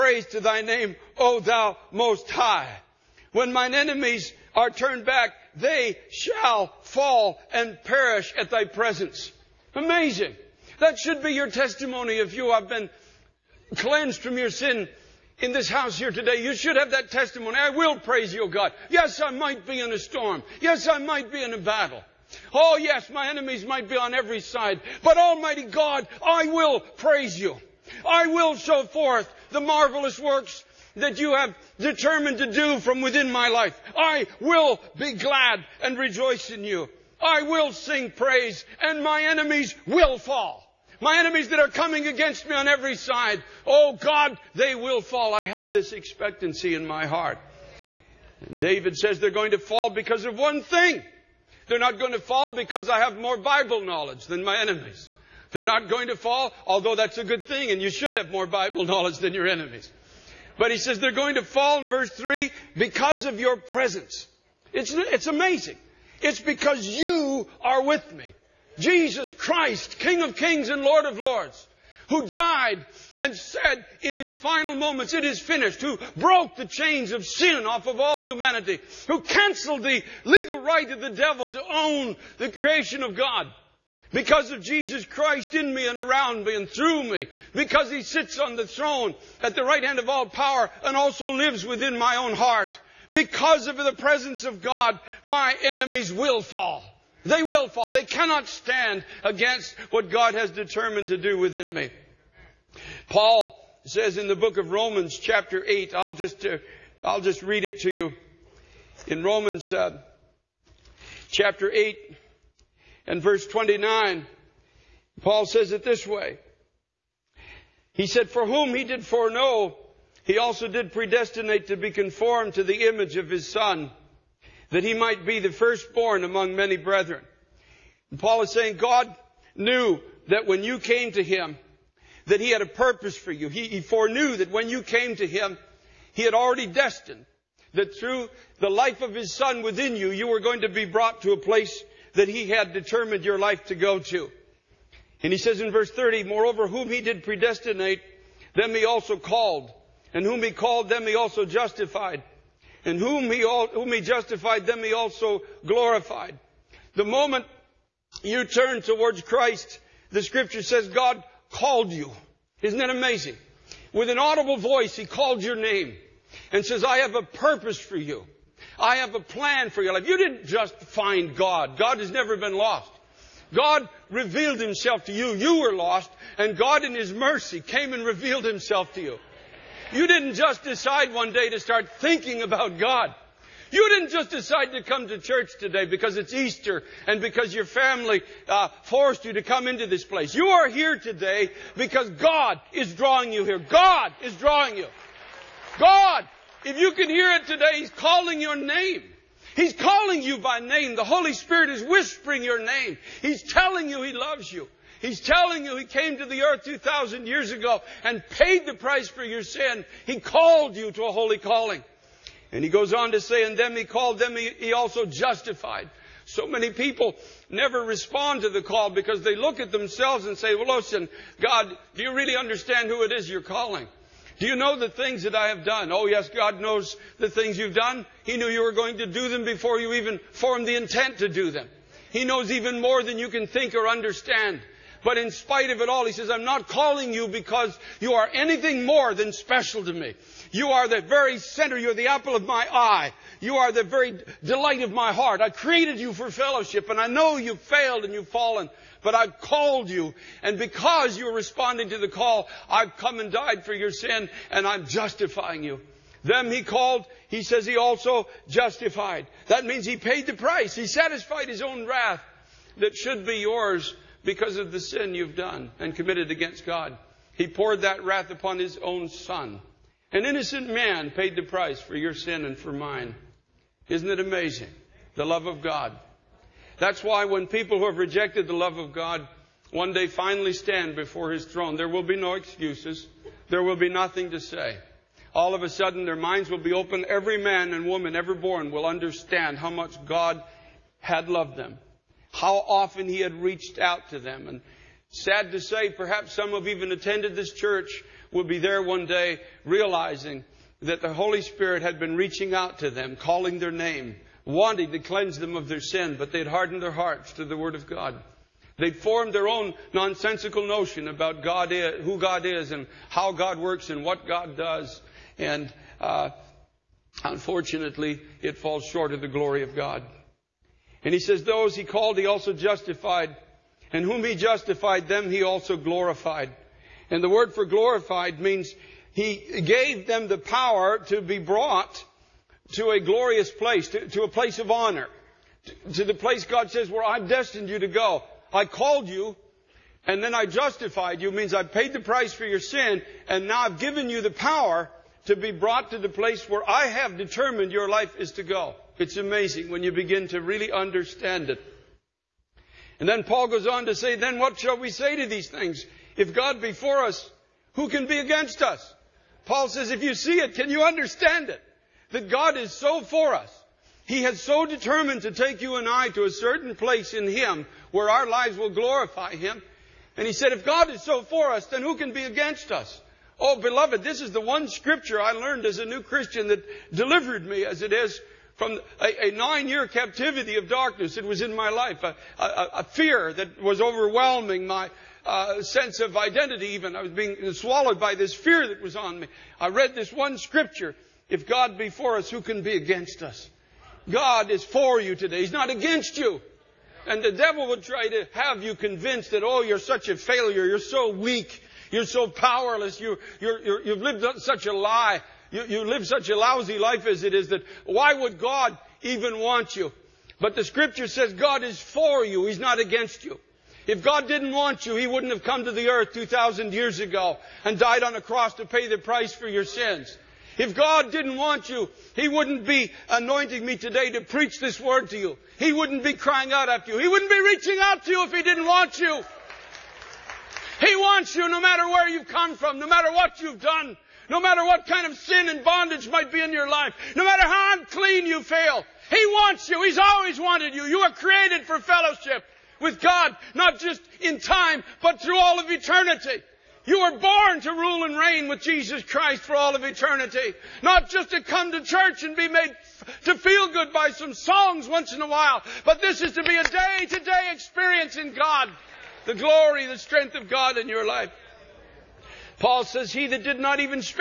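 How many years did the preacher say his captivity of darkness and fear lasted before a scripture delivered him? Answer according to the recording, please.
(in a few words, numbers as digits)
9.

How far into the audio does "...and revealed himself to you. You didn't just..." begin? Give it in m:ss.
2:57.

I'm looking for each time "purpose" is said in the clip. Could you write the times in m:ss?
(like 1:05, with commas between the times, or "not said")
2:12, 2:47.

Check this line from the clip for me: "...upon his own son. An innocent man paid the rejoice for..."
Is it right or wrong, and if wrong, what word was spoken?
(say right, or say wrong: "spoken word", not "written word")
wrong: "price", not "rejoice".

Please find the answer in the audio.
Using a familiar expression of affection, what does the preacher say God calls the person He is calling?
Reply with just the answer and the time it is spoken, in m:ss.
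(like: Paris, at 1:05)
The apple of my eye, at 4:02.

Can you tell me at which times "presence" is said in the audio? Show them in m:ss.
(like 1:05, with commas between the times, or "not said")
0:08, 1:03, 1:33.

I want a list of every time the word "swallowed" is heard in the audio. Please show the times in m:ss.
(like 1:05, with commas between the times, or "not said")
6:27.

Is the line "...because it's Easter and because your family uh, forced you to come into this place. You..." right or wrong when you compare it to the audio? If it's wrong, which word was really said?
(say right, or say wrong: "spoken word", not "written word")
right.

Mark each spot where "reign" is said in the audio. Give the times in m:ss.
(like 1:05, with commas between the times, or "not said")
7:28.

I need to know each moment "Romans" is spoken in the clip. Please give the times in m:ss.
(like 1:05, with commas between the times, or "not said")
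1:44, 1:49.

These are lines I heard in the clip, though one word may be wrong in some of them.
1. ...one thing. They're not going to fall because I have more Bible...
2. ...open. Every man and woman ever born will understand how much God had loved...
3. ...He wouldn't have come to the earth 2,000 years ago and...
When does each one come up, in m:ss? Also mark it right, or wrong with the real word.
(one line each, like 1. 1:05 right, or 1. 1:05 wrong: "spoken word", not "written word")
1. 0:50 right
2. 4:46 right
3. 6:54 right.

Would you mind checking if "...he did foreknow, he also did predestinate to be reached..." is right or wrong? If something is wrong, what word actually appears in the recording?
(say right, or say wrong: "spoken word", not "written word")
wrong: "conformed", not "reached".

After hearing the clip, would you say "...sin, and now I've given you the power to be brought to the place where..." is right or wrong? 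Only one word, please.
right.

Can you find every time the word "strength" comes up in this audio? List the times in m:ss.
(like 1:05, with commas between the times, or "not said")
7:39.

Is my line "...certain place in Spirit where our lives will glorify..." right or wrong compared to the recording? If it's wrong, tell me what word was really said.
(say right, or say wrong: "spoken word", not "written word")
wrong: "Him", not "Spirit".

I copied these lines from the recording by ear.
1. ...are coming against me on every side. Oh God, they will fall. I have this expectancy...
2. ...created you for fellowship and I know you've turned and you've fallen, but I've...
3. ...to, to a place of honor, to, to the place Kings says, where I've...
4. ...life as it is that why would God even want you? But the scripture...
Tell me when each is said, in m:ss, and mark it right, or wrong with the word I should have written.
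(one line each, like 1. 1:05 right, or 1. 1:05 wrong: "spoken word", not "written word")
1. 0:41 right
2. 4:05 wrong: "failed", not "turned"
3. 5:33 wrong: "God", not "Kings"
4. 6:46 right.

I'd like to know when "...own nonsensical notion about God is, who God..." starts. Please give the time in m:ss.
5:09.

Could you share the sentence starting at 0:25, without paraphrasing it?
But Almighty God, I will praise you.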